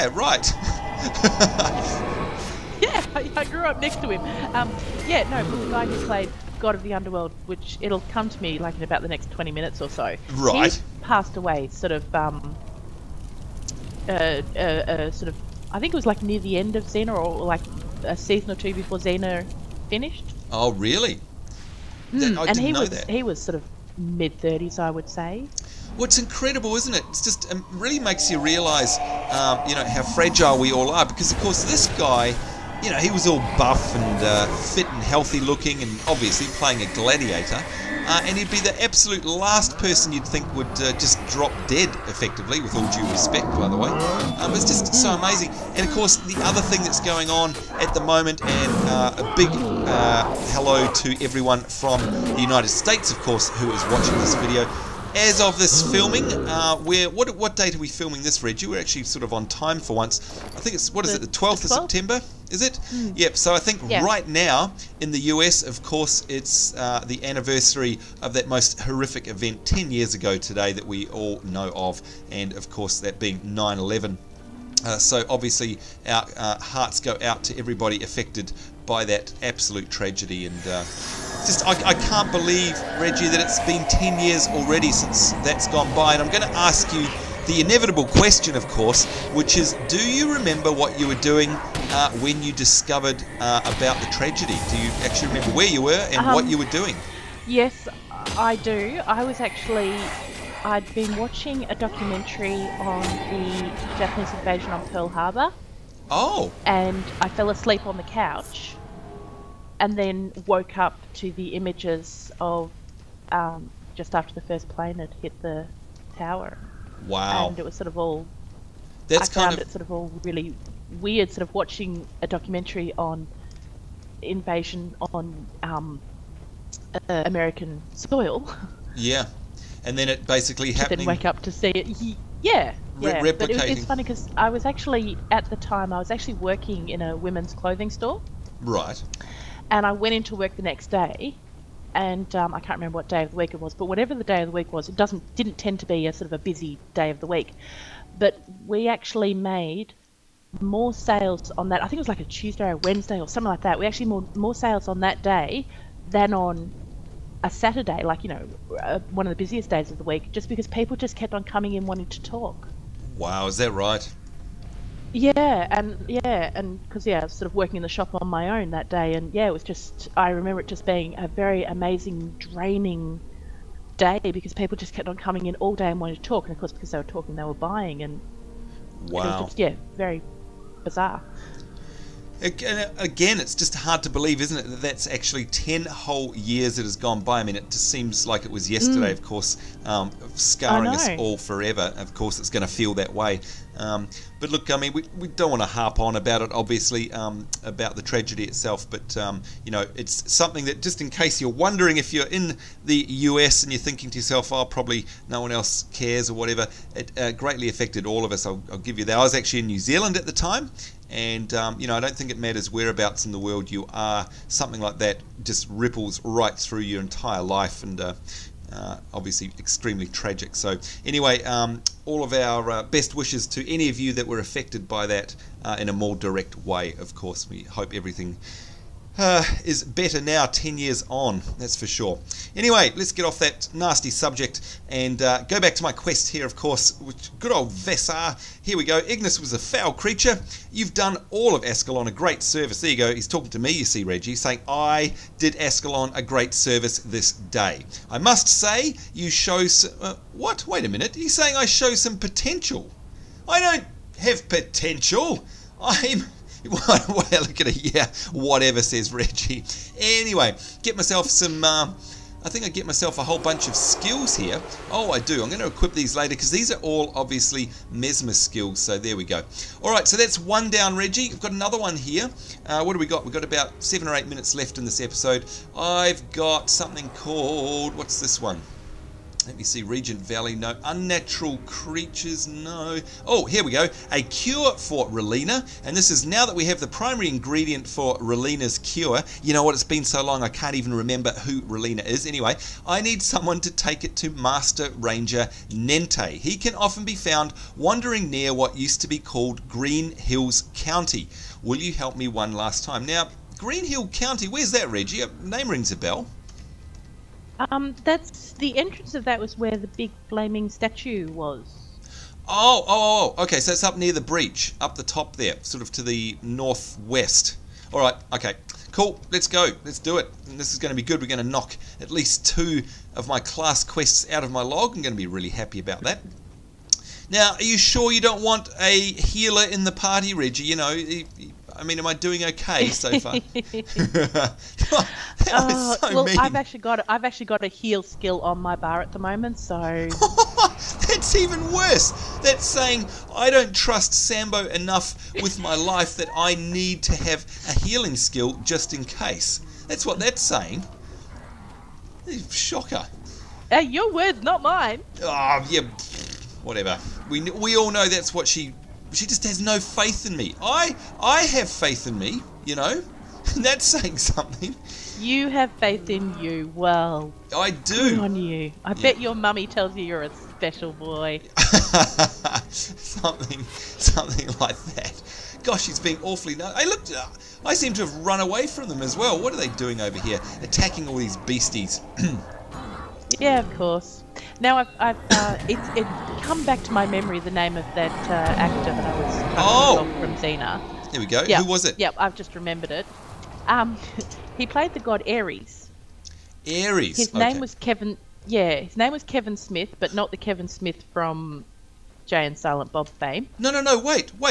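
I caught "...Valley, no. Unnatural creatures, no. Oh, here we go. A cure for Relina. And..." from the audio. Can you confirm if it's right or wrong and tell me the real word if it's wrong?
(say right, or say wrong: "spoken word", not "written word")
right.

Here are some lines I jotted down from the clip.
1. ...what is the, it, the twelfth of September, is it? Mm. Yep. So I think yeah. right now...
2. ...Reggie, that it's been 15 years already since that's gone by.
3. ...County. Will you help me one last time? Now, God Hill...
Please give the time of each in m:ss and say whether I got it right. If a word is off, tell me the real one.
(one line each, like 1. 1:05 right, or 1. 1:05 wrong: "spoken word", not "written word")
1. 1:00 right
2. 1:22 wrong: "10", not "15"
3. 5:00 wrong: "Green", not "God".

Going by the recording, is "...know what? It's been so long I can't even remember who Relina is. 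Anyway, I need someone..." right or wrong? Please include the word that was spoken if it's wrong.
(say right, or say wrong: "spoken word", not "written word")
right.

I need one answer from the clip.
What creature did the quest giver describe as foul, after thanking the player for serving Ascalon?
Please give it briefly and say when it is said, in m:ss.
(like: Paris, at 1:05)
Ignis, at 3:58.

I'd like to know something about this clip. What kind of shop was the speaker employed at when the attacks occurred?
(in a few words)
women's clothing store.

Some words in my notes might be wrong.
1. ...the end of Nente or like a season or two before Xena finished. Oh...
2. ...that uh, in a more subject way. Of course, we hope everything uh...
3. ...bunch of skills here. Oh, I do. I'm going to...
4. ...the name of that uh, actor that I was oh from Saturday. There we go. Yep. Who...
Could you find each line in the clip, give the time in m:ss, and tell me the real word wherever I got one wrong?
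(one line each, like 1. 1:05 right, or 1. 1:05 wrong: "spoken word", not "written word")
1. 0:16 wrong: "Xena", not "Nente"
2. 3:45 wrong: "direct", not "subject"
3. 4:23 right
4. 6:27 wrong: "Xena", not "Saturday".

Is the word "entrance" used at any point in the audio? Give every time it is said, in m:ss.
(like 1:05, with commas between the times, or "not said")
5:08.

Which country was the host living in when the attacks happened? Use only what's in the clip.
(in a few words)
New Zealand.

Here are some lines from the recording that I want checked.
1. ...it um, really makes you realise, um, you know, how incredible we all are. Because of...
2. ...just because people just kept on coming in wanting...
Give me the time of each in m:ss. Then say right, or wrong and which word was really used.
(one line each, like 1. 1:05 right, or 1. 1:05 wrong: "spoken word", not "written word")
1. 0:27 wrong: "fragile", not "incredible"
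2. 2:40 right.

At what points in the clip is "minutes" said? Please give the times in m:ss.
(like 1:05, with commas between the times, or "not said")
0:09, 4:10, 4:34.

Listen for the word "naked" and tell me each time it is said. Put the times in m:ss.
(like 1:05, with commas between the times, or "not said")
not said.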